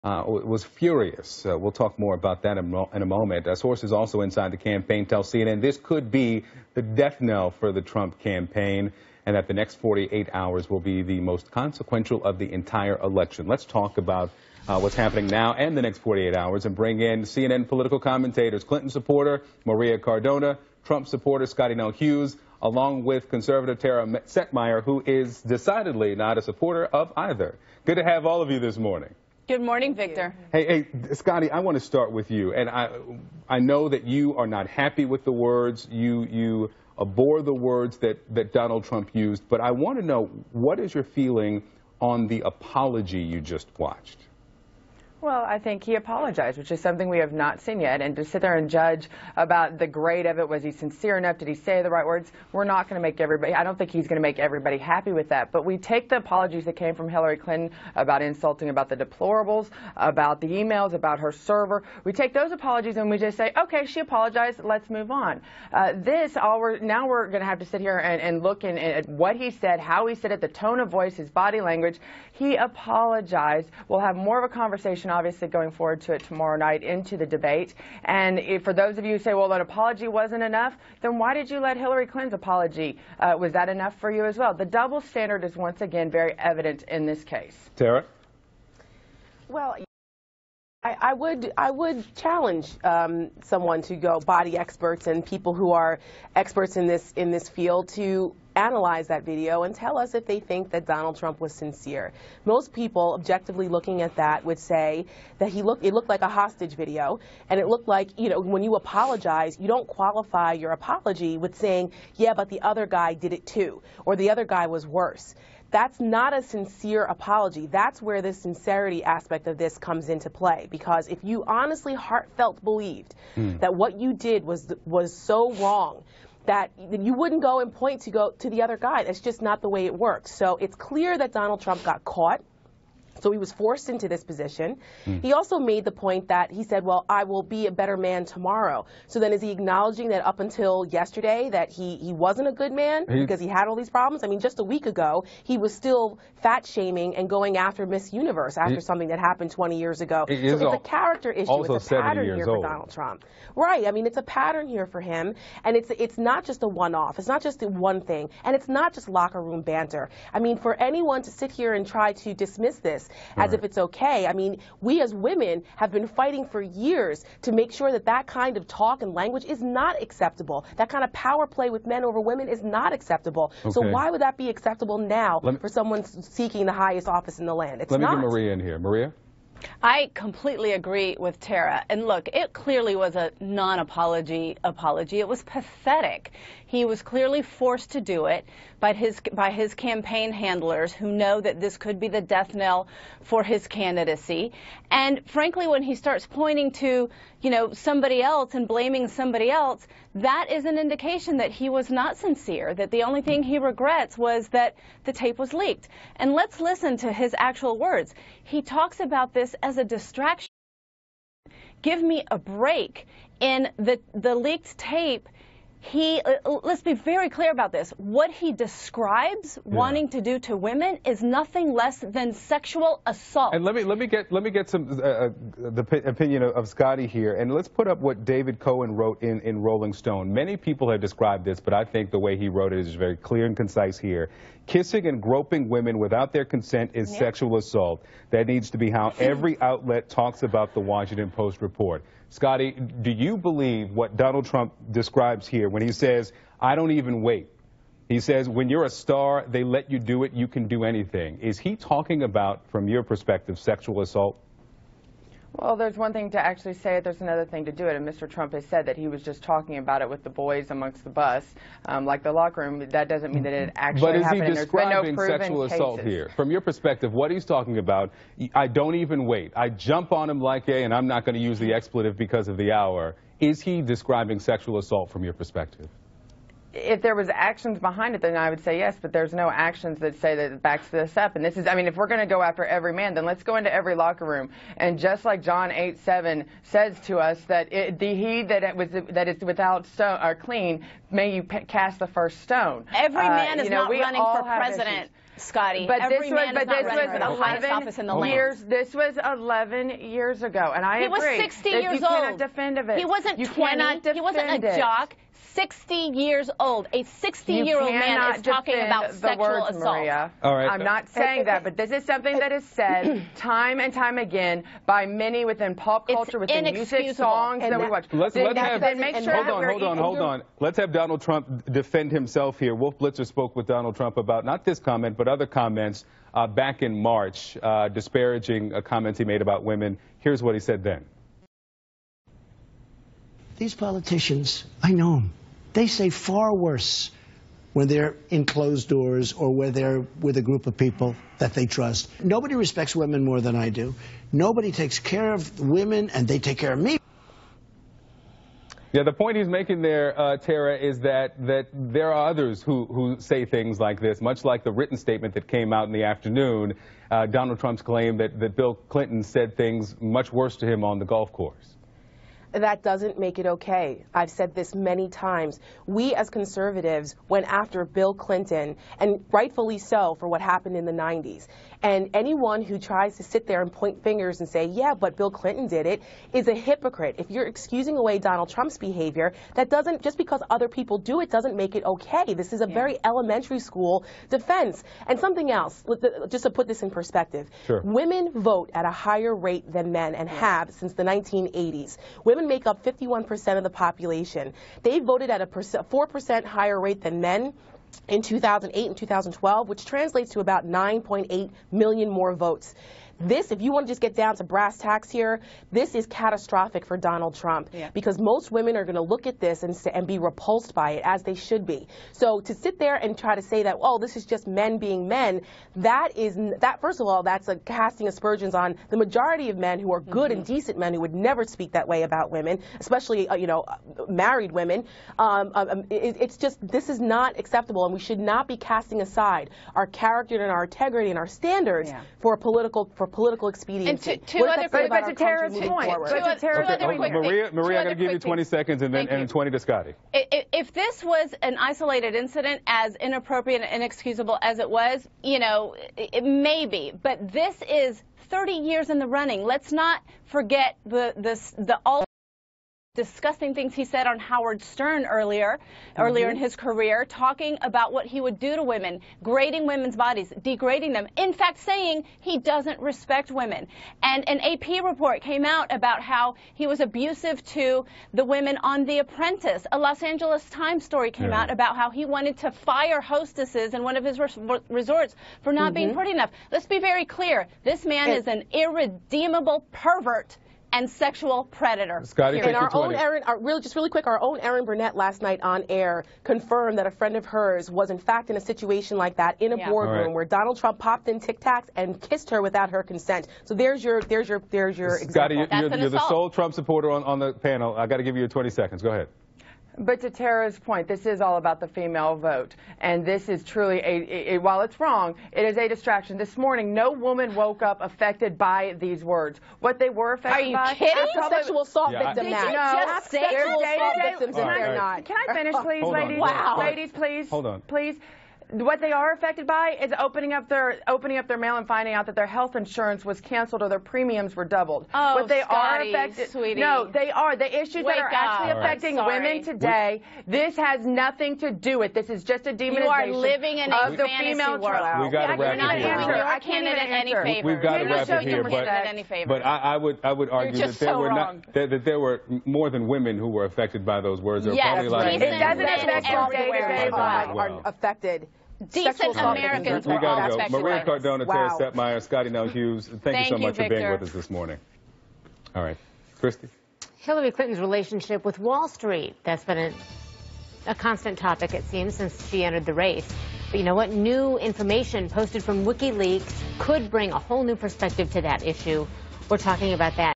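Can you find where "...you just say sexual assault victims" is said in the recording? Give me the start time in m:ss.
8:32.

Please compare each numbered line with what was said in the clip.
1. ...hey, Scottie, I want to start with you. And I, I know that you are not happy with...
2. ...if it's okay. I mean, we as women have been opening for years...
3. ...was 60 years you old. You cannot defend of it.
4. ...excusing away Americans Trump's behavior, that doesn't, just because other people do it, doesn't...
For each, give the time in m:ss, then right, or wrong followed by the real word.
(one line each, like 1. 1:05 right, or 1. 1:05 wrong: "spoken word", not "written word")
1. 0:31 right
2. 2:43 wrong: "fighting", not "opening"
3. 5:01 right
4. 6:17 wrong: "Donald", not "Americans".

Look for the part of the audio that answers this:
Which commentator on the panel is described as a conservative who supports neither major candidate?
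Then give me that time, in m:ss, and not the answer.
0:23.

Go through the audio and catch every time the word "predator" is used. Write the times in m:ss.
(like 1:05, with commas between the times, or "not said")
8:01.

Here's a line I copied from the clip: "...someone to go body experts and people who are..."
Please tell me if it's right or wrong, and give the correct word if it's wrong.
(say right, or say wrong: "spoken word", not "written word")
right.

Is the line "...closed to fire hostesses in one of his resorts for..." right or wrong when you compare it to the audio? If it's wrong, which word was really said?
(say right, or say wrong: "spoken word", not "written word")
wrong: "wanted", not "closed".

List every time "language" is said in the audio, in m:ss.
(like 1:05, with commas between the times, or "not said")
1:11, 2:49.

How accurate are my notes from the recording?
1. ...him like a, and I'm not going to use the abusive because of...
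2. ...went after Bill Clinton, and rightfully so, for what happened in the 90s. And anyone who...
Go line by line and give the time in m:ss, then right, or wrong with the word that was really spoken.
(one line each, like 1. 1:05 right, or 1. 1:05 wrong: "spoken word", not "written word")
1. 4:30 wrong: "expletive", not "abusive"
2. 6:07 right.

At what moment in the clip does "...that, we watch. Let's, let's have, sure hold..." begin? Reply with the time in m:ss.
5:17.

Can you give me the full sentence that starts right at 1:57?
That's where the sincerity aspect of this comes into play.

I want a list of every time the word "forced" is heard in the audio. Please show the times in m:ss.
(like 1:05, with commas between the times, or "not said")
2:13, 3:07.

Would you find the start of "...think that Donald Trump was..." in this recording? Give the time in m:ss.
1:40.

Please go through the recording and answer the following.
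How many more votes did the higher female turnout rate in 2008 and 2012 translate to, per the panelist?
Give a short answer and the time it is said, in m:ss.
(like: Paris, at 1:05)
9.8 million, at 6:40.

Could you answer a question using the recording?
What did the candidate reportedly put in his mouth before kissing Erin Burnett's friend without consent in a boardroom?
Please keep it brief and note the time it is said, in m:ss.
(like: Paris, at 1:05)
Tic Tacs, at 8:11.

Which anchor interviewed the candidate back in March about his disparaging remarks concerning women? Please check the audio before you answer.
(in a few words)
Wolf Blitzer.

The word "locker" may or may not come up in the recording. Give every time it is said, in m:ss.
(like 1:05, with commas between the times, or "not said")
2:39, 4:22, 4:43.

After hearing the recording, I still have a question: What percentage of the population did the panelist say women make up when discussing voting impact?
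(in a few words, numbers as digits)
51%.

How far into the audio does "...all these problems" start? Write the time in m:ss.
2:23.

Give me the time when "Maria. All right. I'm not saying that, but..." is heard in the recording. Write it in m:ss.
5:09.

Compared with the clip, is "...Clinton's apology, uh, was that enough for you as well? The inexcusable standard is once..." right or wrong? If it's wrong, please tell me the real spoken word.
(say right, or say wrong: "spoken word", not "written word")
wrong: "double", not "inexcusable".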